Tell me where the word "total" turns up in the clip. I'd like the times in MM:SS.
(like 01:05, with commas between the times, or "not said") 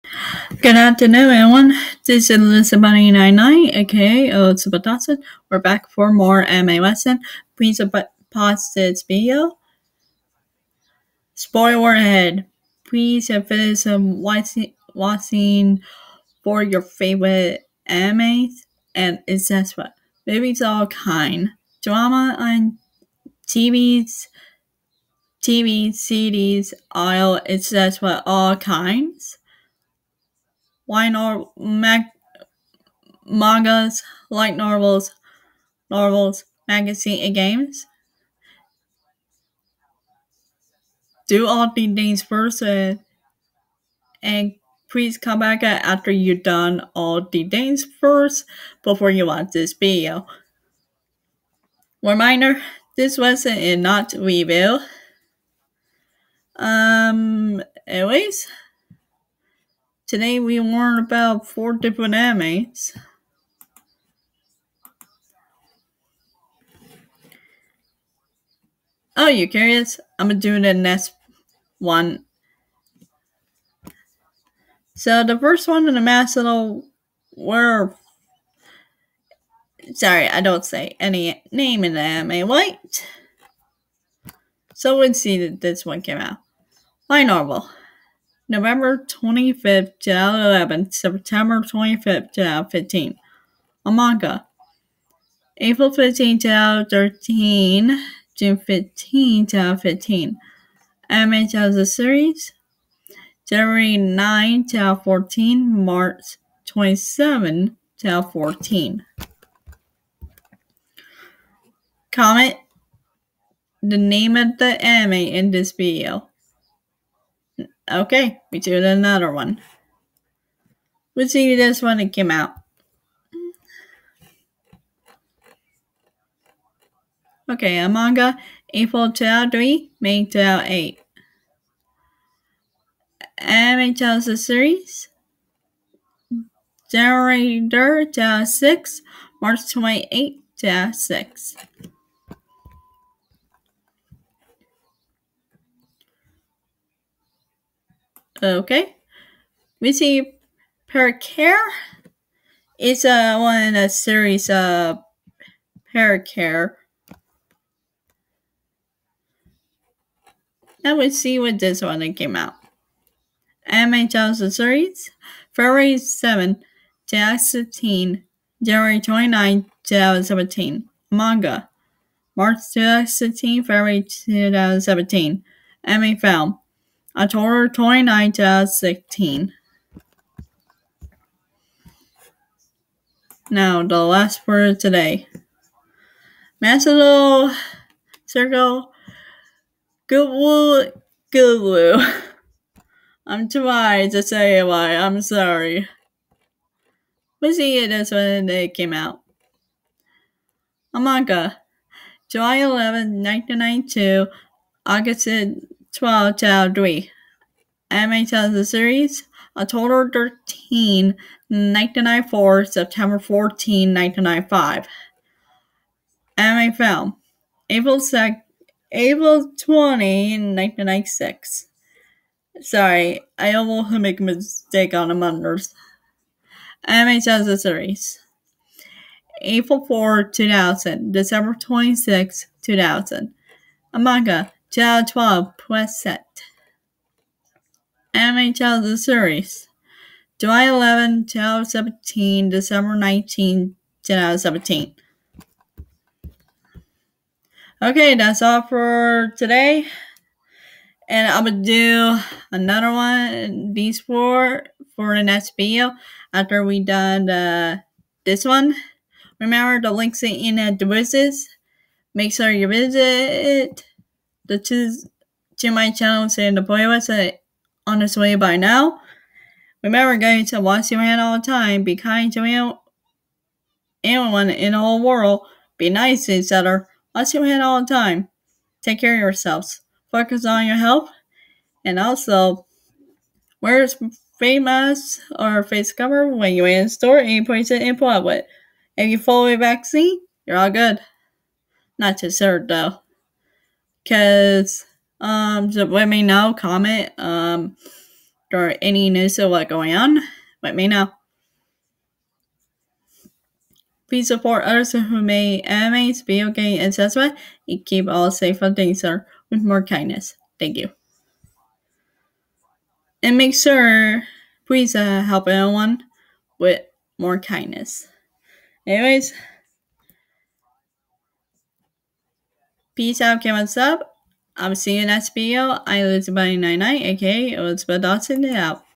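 03:29.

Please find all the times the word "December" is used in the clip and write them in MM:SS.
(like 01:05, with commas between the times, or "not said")
03:51, 04:02.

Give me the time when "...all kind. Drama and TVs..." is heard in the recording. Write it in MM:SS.
00:20.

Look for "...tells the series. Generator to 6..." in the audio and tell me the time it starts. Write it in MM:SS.
02:13.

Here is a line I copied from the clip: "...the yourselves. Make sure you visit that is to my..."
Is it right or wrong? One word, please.
wrong.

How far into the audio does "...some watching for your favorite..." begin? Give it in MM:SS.
00:13.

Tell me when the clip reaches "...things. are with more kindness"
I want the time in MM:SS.
05:08.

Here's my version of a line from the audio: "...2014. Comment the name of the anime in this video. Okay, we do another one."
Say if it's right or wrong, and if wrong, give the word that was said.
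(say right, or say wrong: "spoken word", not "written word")
right.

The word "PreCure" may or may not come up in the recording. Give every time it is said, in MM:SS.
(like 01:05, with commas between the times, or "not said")
02:30, 02:35.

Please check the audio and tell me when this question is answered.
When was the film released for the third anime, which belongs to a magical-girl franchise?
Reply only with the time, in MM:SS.
02:57.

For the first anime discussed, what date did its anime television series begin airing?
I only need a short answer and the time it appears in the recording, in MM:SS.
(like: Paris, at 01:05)
January 9, 2014, at 01:43.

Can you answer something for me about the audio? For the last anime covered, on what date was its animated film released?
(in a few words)
April 20, 1996.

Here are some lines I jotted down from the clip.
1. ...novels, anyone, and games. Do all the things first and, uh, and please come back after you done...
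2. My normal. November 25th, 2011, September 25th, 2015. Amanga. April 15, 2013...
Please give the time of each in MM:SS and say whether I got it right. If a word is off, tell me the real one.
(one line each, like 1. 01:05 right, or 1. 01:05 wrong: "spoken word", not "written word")
1. 00:35 wrong: "magazine", not "anyone"
2. 01:27 right.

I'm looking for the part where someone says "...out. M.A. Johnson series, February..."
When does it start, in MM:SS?
02:42.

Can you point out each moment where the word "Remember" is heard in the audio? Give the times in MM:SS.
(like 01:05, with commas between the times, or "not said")
04:19, 04:29.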